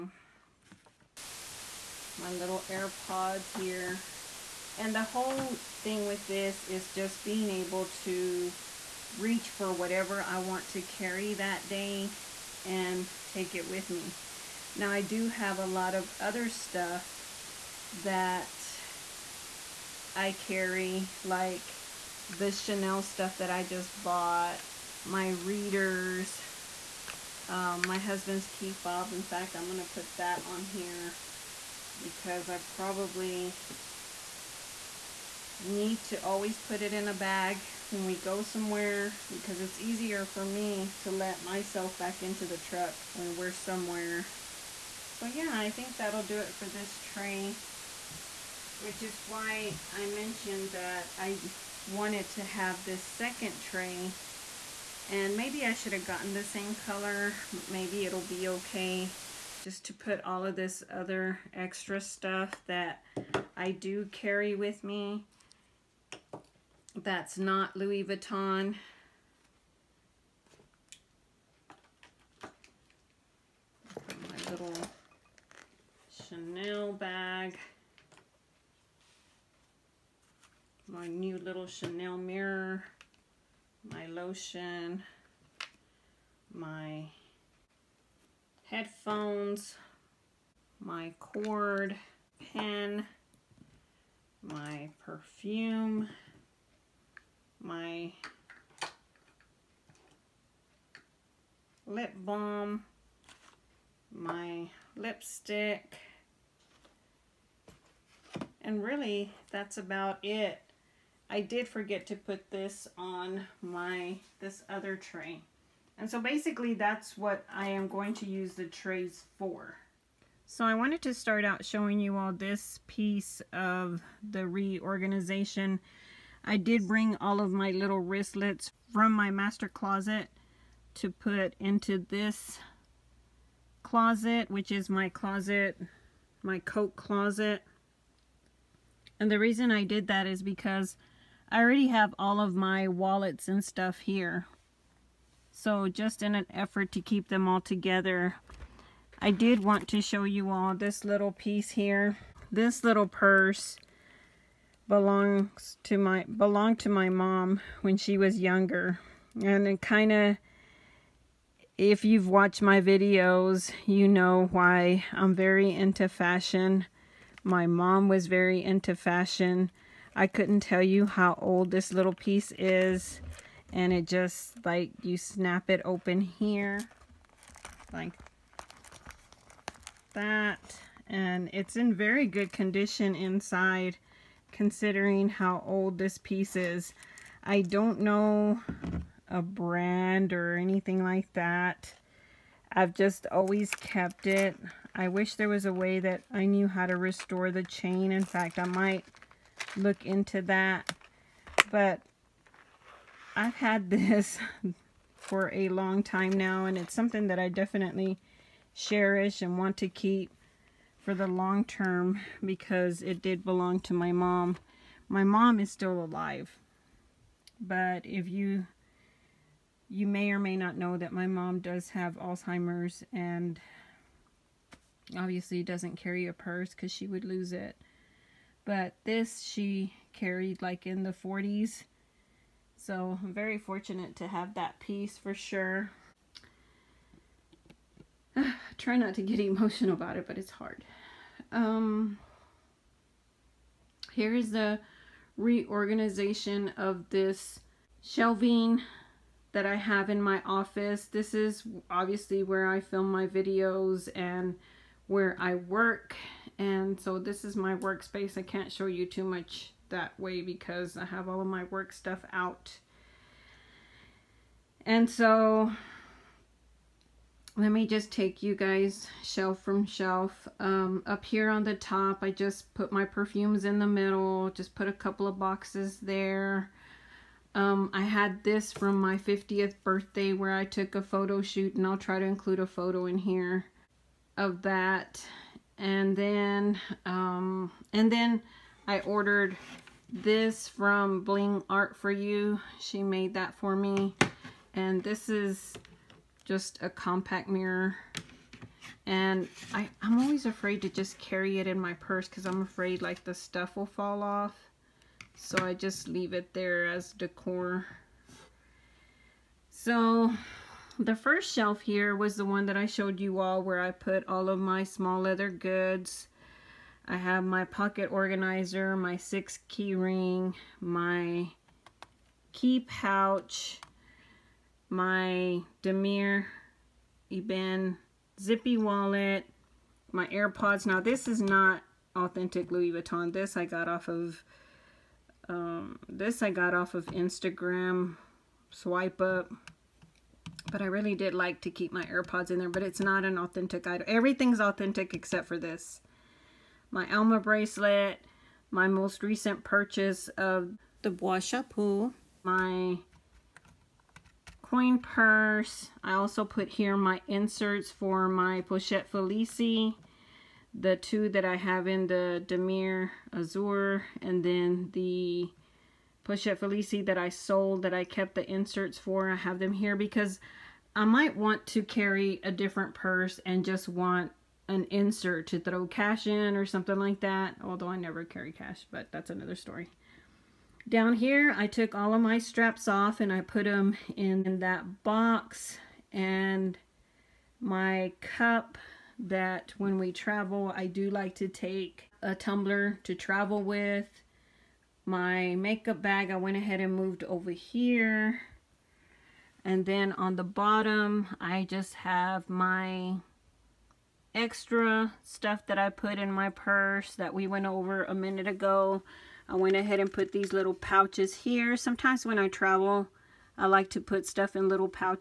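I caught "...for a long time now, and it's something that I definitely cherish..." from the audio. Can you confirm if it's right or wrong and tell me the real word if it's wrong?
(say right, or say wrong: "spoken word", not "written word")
right.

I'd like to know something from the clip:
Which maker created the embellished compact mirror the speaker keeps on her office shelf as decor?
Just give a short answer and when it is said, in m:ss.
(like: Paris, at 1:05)
Bling Art For You, at 4:51.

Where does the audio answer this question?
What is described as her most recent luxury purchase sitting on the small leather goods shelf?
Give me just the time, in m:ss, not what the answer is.
5:51.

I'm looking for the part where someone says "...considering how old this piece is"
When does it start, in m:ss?
3:04.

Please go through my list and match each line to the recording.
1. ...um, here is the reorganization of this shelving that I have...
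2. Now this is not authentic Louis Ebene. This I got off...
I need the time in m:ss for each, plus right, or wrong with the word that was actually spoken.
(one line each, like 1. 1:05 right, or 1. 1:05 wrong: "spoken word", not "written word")
1. 4:01 right
2. 5:30 wrong: "Vuitton", not "Ebene".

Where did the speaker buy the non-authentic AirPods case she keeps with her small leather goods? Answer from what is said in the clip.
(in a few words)
Instagram.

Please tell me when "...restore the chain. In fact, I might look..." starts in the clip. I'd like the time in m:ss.
3:16.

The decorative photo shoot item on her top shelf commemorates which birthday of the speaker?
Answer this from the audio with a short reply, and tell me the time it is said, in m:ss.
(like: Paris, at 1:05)
50th, at 4:39.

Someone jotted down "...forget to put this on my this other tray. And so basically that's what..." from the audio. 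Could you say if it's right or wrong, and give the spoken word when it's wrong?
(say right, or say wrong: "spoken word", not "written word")
right.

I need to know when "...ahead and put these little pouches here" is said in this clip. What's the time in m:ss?
6:49.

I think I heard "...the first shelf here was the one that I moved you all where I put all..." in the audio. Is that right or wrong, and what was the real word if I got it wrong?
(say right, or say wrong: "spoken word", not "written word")
wrong: "showed", not "moved".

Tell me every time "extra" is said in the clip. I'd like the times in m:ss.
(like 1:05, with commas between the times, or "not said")
1:01, 6:44.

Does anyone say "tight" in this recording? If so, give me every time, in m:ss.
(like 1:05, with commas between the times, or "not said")
not said.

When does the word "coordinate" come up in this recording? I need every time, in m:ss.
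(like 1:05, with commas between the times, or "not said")
not said.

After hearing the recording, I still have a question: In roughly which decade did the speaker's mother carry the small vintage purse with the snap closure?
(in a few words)
the 40s.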